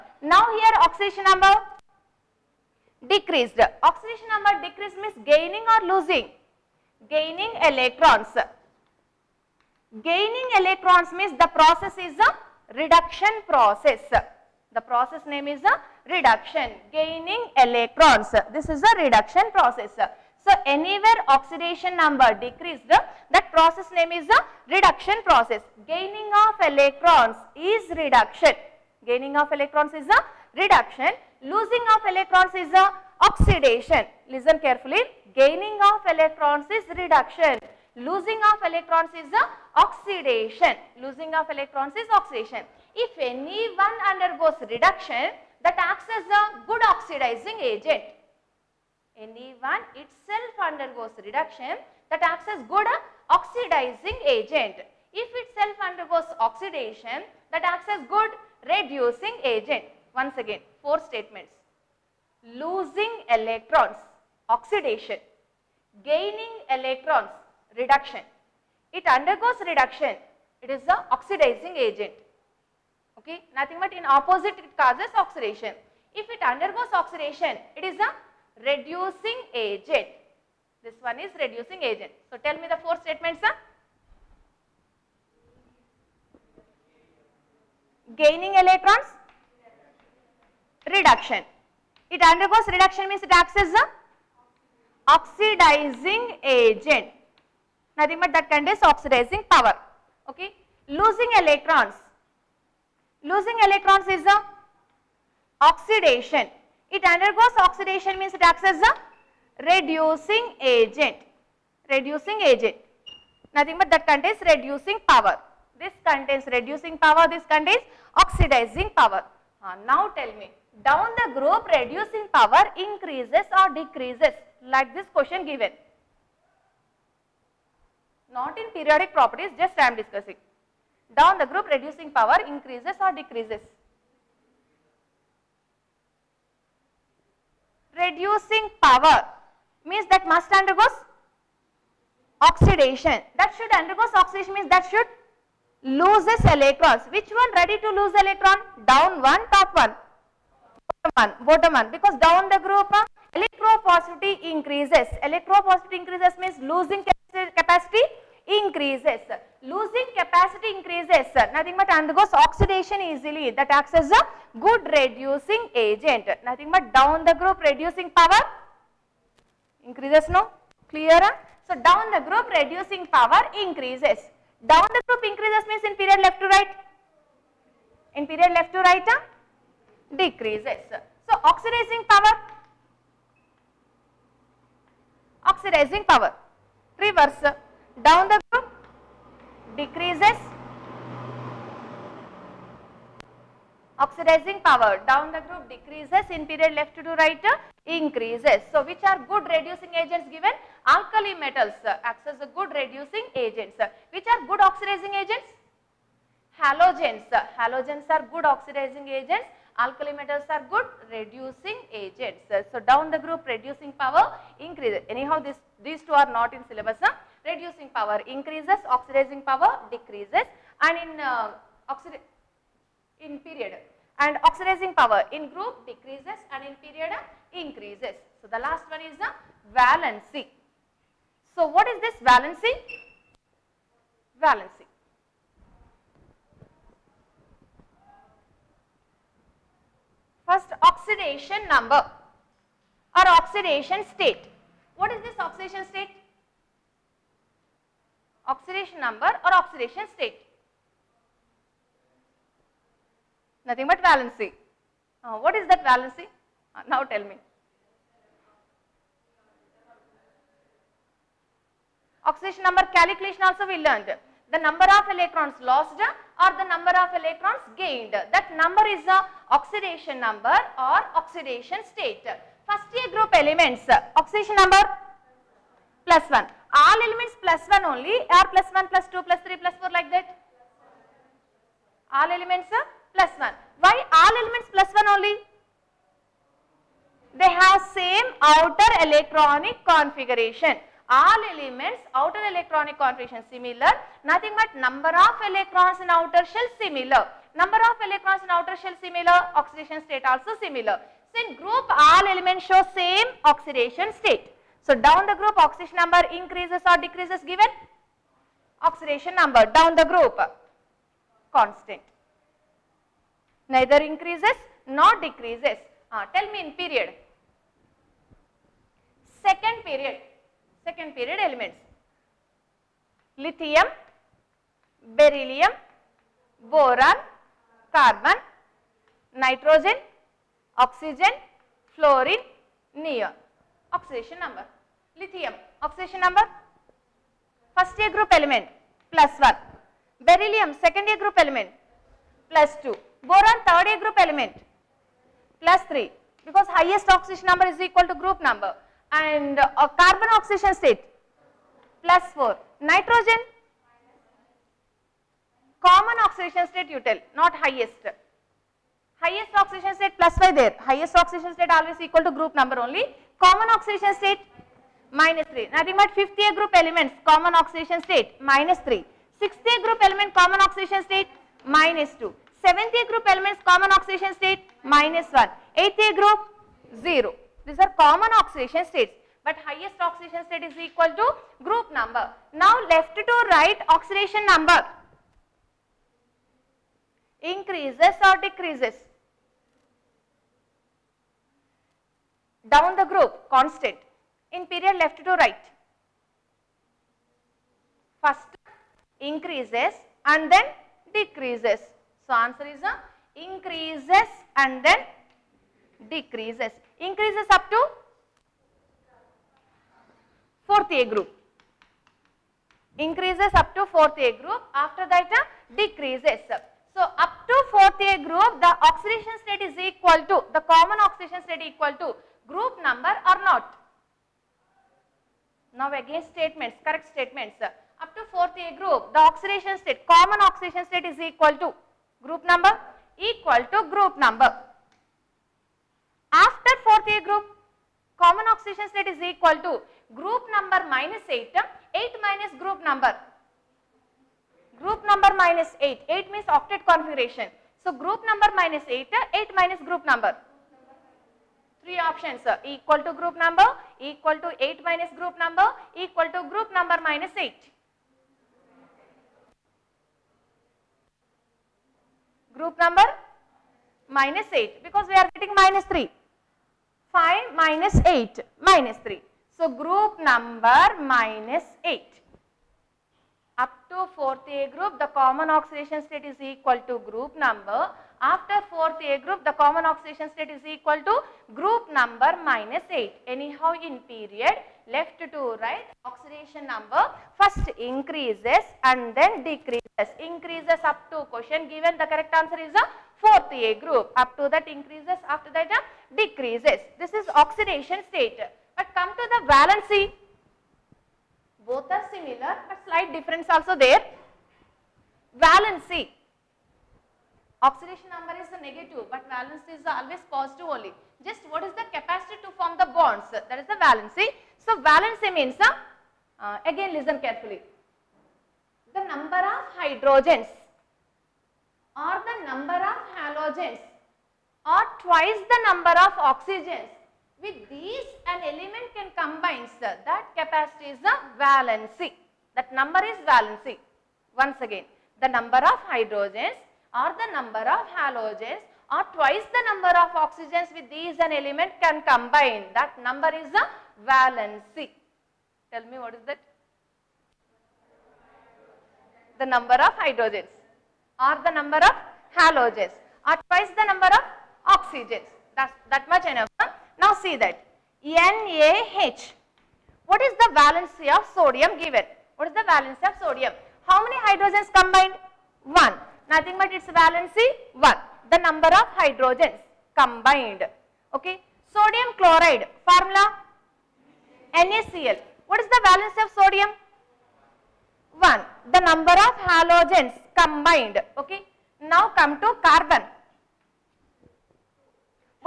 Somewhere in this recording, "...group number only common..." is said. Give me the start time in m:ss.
6:02.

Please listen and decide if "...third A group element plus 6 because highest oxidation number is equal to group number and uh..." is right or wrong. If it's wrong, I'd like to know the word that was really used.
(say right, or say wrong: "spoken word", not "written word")
wrong: "3", not "6".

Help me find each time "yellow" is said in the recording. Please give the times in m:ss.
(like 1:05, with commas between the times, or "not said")
not said.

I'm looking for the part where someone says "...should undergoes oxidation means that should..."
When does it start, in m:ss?
2:23.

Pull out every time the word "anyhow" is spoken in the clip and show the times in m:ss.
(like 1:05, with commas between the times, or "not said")
3:35, 8:03.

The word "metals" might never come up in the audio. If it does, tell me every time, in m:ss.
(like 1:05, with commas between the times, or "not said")
3:21, 3:30.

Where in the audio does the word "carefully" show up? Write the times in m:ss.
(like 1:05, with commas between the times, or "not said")
0:34, 8:37.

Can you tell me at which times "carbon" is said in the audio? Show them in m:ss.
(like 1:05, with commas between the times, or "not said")
5:27, 5:49, 9:42.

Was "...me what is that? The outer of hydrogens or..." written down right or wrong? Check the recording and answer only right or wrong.
wrong.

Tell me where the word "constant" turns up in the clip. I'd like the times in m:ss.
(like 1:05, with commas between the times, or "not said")
5:11, 6:33.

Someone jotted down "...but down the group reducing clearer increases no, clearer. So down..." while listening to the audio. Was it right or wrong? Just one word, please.
wrong.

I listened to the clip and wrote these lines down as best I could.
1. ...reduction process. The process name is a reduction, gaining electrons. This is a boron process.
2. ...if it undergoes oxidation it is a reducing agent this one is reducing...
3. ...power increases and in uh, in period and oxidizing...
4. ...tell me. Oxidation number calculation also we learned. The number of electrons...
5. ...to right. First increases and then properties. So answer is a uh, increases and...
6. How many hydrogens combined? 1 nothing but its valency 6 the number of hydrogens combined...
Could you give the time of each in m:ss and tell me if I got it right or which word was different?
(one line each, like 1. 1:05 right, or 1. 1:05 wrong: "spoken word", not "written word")
1. 0:12 wrong: "reduction", not "boron"
2. 1:16 right
3. 3:39 wrong: "decreases", not "increases"
4. 4:17 right
5. 6:35 wrong: "decreases", not "properties"
6. 9:23 wrong: "1", not "6".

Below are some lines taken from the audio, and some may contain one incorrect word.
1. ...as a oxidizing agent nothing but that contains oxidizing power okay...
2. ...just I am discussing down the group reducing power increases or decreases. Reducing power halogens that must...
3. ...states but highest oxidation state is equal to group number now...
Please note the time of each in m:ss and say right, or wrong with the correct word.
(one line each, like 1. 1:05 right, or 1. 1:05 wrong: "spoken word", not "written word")
1. 1:33 right
2. 2:09 wrong: "means", not "halogens"
3. 6:18 right.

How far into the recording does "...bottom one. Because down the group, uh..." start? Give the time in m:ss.
2:31.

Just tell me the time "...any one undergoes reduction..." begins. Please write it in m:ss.
0:43.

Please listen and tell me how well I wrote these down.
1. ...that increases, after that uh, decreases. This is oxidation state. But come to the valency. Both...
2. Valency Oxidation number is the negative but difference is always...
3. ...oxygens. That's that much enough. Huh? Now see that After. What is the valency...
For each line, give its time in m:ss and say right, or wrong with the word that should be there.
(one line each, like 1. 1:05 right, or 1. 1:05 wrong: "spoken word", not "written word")
1. 8:14 right
2. 8:25 wrong: "valence", not "difference"
3. 9:14 wrong: "NaH", not "After".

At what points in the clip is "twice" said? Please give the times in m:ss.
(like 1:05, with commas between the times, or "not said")
8:44, 8:59, 9:13.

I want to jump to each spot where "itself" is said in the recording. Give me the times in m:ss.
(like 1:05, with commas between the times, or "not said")
0:49, 0:55.